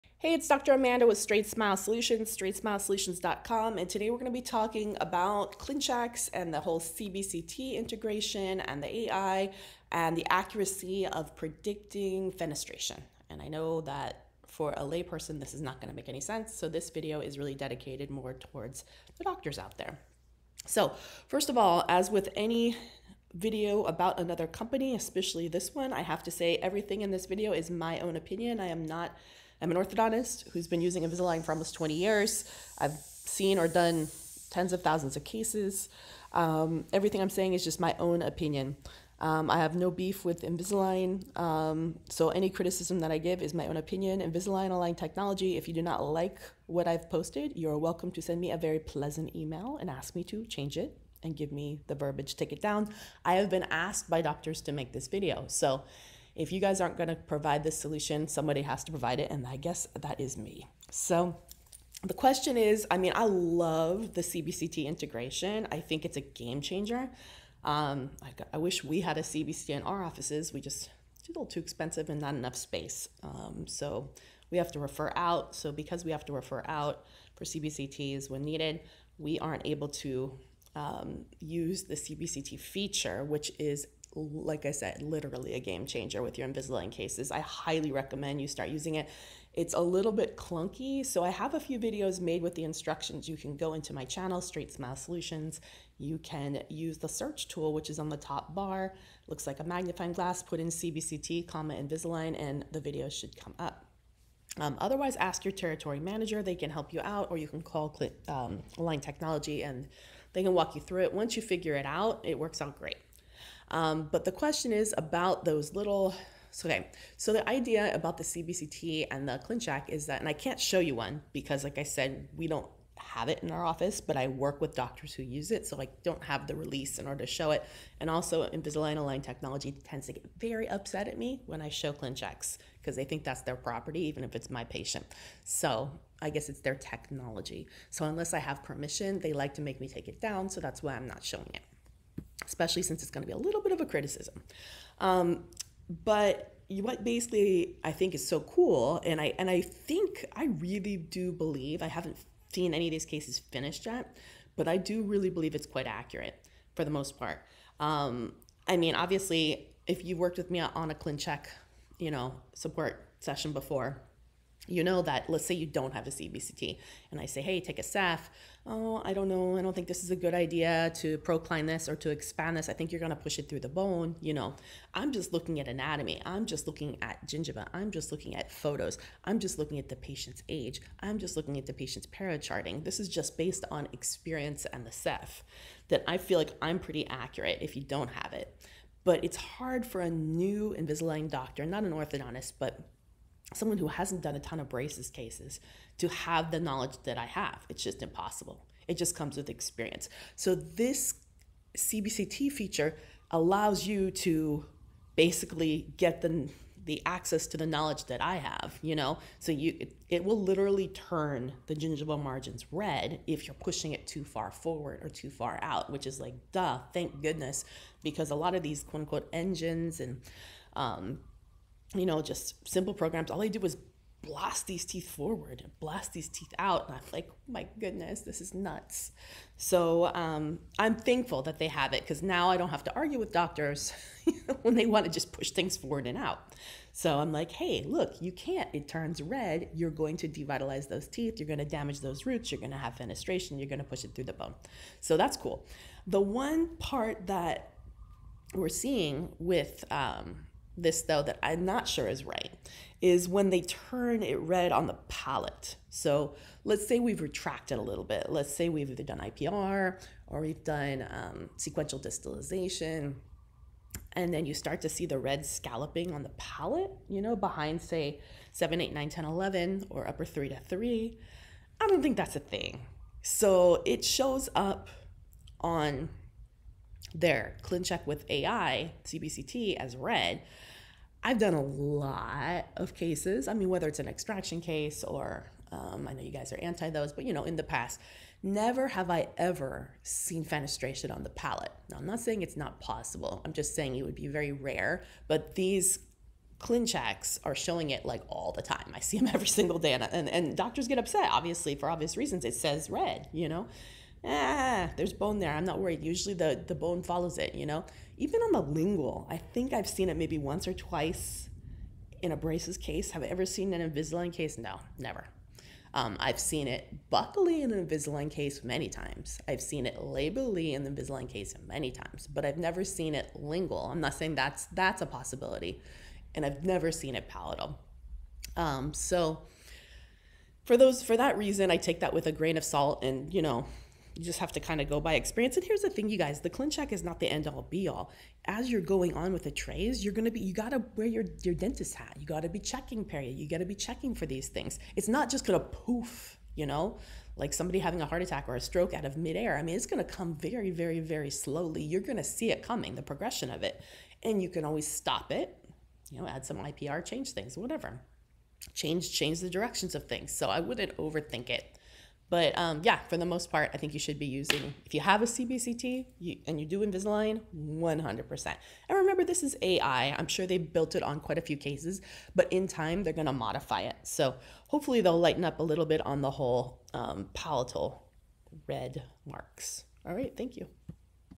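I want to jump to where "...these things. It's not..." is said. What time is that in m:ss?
5:44.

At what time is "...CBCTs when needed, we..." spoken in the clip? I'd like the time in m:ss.
1:17.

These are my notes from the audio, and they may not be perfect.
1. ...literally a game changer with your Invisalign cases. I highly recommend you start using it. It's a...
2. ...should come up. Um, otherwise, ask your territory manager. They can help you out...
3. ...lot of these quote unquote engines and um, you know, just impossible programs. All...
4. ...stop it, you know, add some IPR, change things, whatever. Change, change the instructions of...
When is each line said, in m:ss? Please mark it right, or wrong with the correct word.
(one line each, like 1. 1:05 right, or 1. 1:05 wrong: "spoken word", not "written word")
1. 1:25 right
2. 1:43 right
3. 3:38 wrong: "simple", not "impossible"
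4. 5:54 wrong: "directions", not "instructions".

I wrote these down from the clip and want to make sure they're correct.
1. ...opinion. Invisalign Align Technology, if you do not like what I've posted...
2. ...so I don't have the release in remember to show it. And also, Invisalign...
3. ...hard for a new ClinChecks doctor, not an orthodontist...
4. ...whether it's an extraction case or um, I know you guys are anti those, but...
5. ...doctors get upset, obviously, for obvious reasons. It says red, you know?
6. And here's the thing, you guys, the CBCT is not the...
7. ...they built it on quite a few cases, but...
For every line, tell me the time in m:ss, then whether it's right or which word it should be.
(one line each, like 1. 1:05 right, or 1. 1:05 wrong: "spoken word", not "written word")
1. 0:43 right
2. 2:05 wrong: "order", not "remember"
3. 3:09 wrong: "Invisalign", not "ClinChecks"
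4. 4:43 right
5. 5:00 right
6. 5:35 wrong: "ClinCheck", not "CBCT"
7. 6:10 right.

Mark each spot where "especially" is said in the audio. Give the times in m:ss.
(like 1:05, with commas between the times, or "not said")
0:24, 2:22.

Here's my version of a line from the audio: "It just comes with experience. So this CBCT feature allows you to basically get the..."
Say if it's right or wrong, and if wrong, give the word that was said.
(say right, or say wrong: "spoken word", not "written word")
right.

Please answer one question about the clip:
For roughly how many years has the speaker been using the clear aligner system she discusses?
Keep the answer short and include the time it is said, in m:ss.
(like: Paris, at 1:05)
almost 20 years, at 0:31.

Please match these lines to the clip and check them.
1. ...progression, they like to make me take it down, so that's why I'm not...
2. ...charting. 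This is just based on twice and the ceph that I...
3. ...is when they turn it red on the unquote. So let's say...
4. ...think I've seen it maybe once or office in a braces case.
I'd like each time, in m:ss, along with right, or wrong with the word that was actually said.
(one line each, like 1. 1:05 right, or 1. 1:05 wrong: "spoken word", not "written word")
1. 2:18 wrong: "permission", not "progression"
2. 3:02 wrong: "experience", not "twice"
3. 4:13 wrong: "palate", not "unquote"
4. 5:09 wrong: "twice", not "office".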